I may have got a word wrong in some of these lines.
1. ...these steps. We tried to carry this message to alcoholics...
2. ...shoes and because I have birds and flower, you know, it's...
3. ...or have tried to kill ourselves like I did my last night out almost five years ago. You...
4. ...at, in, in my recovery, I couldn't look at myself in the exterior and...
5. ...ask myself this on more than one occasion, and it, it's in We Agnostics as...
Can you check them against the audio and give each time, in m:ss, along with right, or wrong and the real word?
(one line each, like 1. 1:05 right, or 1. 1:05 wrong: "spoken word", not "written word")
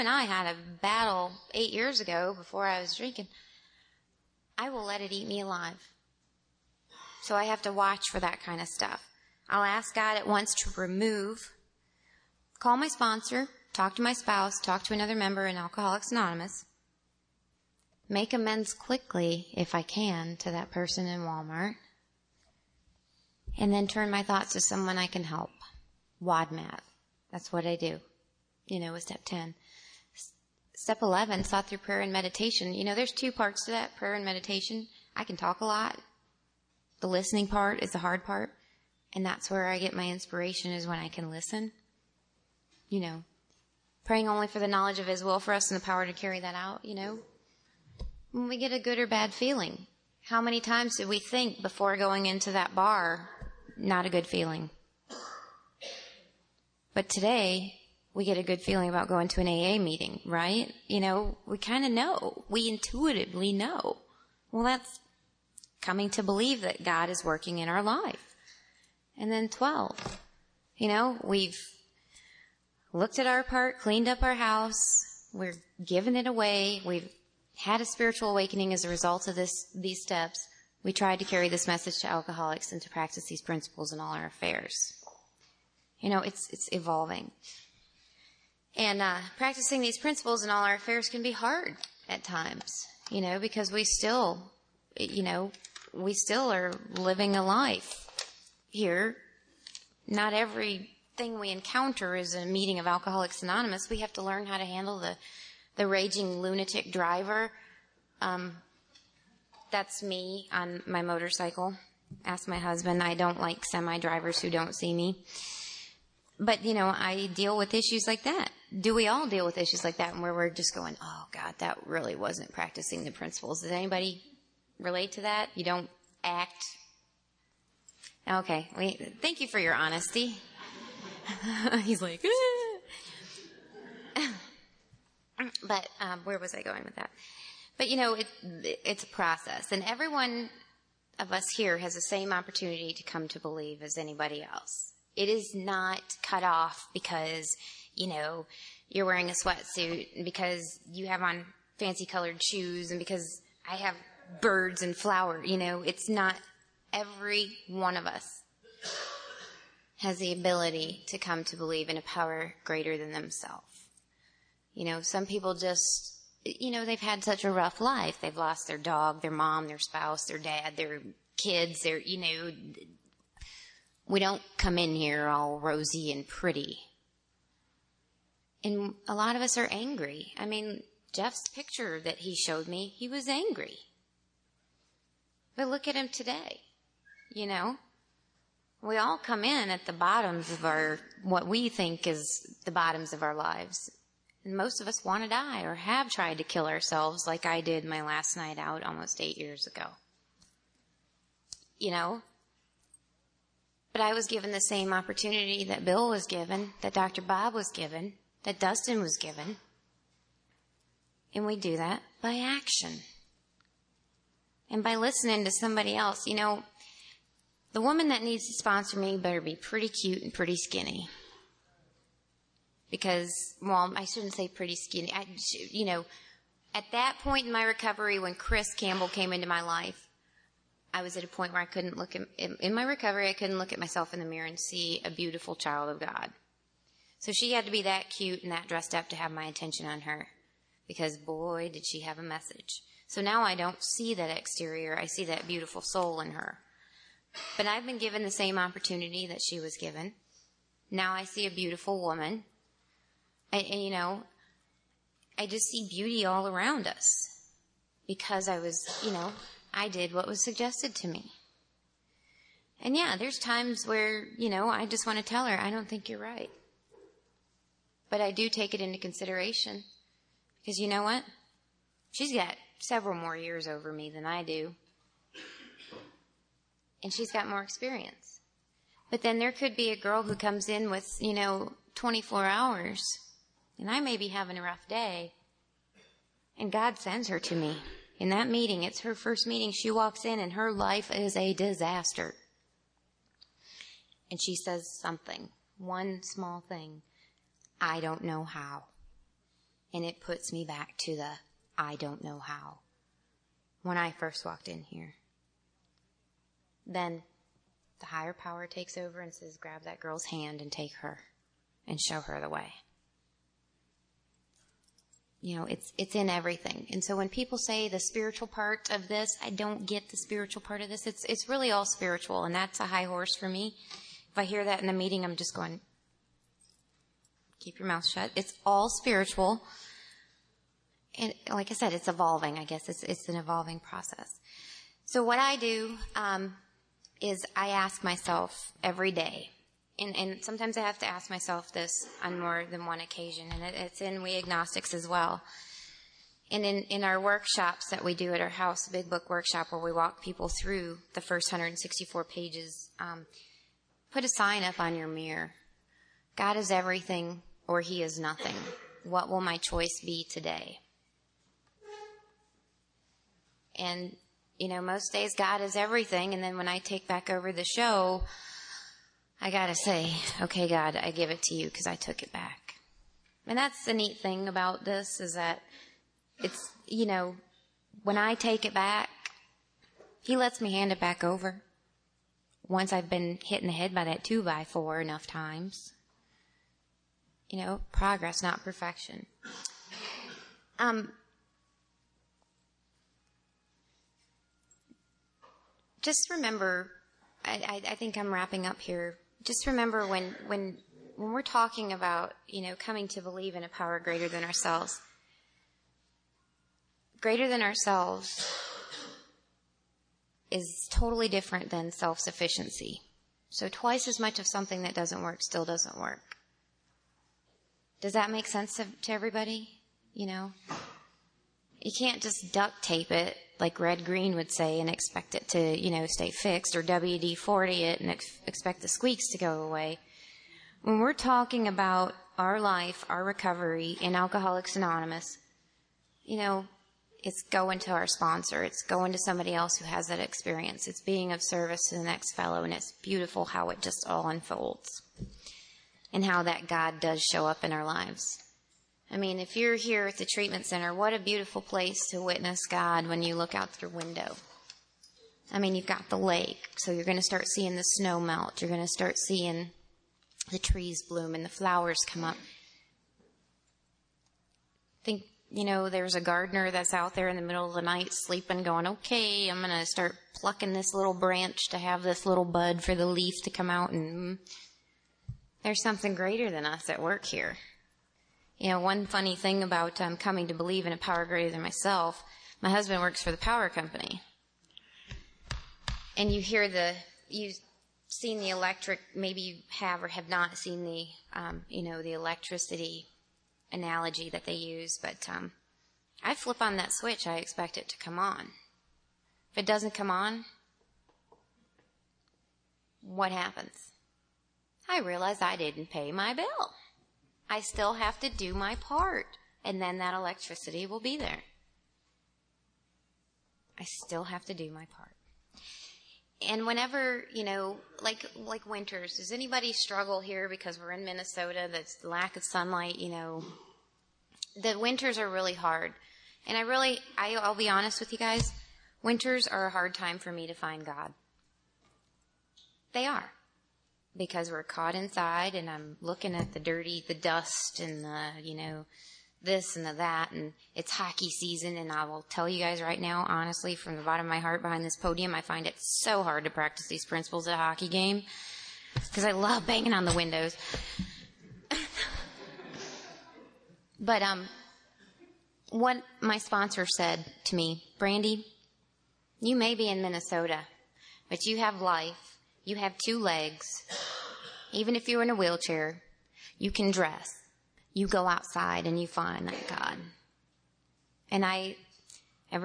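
1. 1:19 right
2. 2:32 right
3. 3:15 wrong: "eight", not "five"
4. 3:52 wrong: "mirror", not "exterior"
5. 5:41 right.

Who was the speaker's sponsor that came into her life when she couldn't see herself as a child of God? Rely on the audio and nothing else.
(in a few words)
Chris Campbell.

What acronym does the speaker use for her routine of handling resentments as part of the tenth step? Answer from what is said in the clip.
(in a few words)
WADMAT.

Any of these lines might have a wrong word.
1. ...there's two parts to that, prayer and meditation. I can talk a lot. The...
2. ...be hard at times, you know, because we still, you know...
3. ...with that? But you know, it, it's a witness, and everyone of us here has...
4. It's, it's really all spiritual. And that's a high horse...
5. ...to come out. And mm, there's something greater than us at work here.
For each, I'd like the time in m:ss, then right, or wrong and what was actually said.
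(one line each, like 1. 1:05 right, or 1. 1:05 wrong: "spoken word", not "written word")
1. 0:32 right
2. 1:31 right
3. 2:16 wrong: "process", not "witness"
4. 5:21 right
5. 7:53 right.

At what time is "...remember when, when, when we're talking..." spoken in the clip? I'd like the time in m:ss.
6:39.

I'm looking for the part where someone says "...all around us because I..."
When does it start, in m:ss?
4:16.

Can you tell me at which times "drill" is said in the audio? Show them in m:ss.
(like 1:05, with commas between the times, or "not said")
not said.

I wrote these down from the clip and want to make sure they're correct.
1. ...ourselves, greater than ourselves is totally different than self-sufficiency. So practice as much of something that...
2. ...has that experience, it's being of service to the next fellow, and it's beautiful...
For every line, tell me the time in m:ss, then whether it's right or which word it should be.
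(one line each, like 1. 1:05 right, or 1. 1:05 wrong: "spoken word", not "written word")
1. 6:44 wrong: "twice", not "practice"
2. 7:19 right.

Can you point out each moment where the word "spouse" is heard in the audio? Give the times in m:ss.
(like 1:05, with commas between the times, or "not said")
0:14, 2:49.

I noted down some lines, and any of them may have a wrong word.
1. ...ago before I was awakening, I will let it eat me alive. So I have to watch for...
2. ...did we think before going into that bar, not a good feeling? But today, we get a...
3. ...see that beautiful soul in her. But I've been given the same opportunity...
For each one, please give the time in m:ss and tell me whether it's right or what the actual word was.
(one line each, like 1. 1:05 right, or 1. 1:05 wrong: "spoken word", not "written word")
1. 0:01 wrong: "drinking", not "awakening"
2. 0:50 right
3. 4:05 right.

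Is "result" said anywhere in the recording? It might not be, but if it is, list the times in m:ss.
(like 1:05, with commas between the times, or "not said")
1:18.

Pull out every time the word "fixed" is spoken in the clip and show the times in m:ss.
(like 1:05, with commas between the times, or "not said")
7:06.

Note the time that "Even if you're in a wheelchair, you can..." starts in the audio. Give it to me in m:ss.
9:24.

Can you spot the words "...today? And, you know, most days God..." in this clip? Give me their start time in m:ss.
6:00.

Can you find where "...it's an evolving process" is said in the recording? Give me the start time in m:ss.
5:33.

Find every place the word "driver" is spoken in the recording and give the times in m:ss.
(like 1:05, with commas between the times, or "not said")
1:46, 1:53.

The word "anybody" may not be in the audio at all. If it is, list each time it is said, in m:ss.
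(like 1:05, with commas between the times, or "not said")
2:03, 2:23, 8:39.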